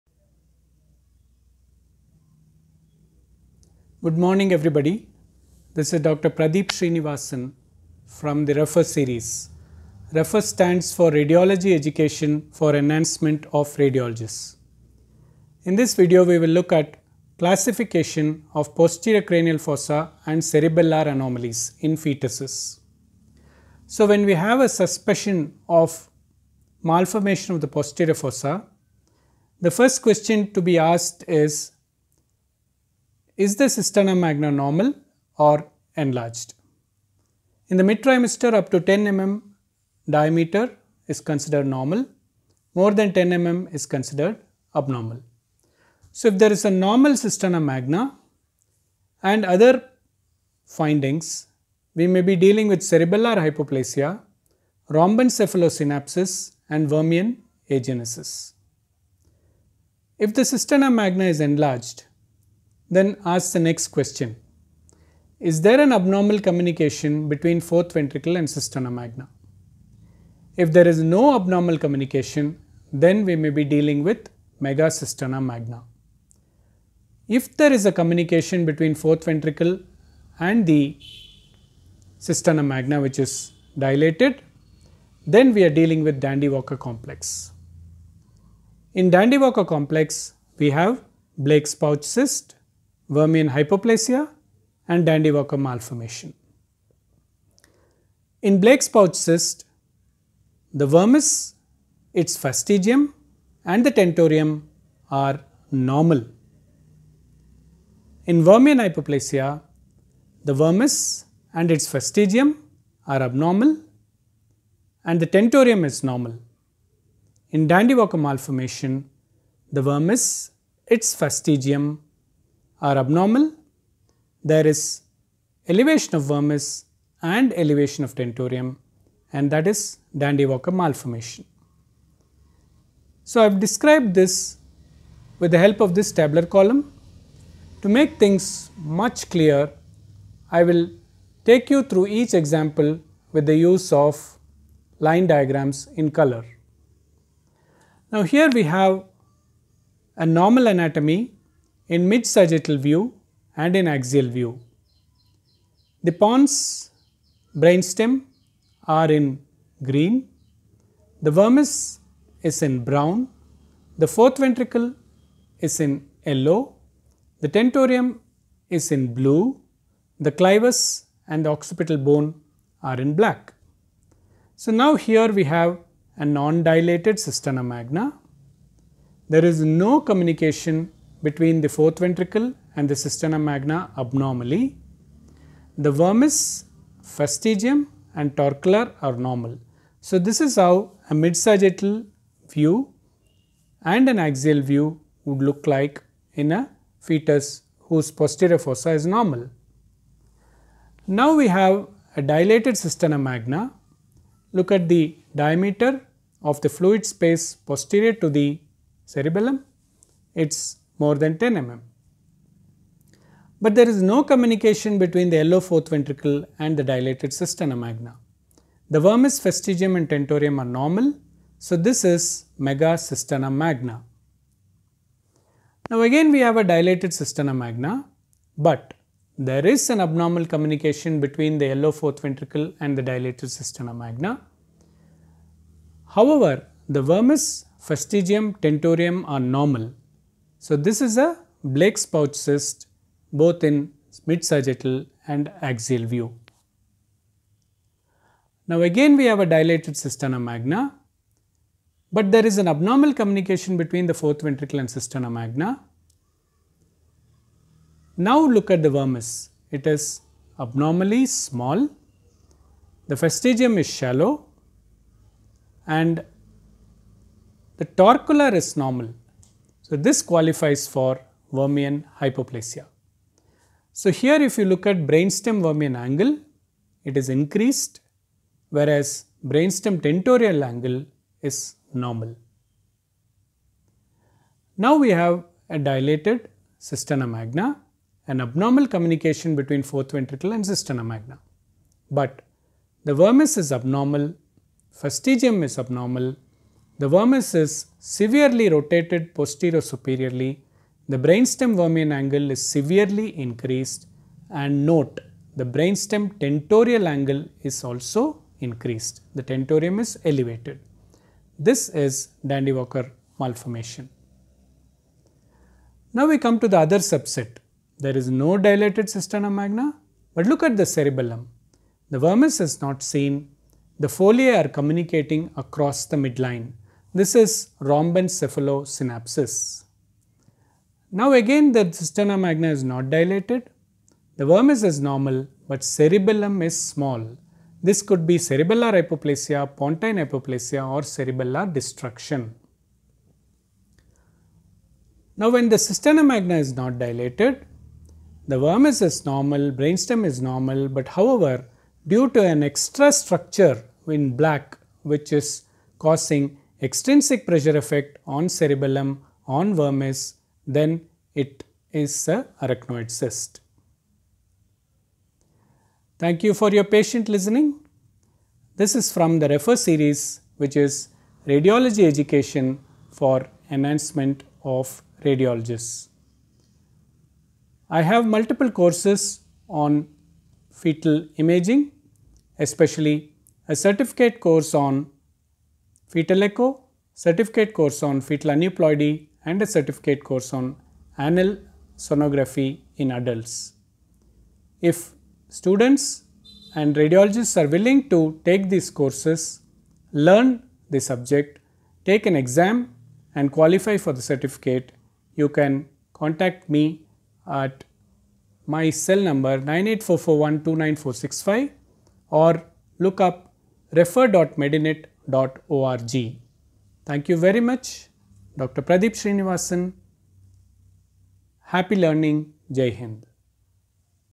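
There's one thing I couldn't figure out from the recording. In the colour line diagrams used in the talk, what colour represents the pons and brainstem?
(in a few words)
Green.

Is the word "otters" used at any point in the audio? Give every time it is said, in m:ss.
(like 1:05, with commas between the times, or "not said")
not said.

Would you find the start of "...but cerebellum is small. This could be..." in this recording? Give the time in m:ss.
5:35.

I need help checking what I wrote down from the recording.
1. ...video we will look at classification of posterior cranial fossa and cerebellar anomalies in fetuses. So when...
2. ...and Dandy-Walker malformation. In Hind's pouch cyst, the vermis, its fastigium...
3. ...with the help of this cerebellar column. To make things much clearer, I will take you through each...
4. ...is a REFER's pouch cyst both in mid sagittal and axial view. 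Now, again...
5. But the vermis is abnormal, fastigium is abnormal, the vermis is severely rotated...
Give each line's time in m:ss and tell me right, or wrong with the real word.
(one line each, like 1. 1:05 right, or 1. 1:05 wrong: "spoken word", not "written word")
1. 0:15 right
2. 1:34 wrong: "Blake", not "Hind"
3. 2:15 wrong: "tabular", not "cerebellar"
4. 4:01 wrong: "Blake", not "REFER"
5. 4:52 right.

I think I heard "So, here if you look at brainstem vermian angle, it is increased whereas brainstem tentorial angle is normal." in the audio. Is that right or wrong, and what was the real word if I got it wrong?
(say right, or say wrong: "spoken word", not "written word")
right.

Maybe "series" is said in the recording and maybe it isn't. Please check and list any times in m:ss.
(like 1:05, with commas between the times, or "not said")
0:08, 6:09.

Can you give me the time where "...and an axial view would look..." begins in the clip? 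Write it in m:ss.
3:13.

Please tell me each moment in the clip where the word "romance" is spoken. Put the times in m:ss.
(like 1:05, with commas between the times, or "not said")
not said.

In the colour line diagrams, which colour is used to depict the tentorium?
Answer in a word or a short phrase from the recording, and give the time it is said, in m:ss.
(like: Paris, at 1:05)
Blue, at 2:49.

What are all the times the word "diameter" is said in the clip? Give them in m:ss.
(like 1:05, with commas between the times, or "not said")
0:40, 3:25.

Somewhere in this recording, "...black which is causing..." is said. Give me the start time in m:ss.
5:54.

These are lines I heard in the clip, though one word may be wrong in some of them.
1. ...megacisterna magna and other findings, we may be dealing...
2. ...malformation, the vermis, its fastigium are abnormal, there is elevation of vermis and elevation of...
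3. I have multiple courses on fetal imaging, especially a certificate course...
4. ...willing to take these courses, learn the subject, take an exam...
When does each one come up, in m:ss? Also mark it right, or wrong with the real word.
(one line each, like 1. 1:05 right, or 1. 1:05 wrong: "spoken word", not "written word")
1. 0:47 wrong: "cisterna", not "megacisterna"
2. 1:58 right
3. 6:17 right
4. 6:37 right.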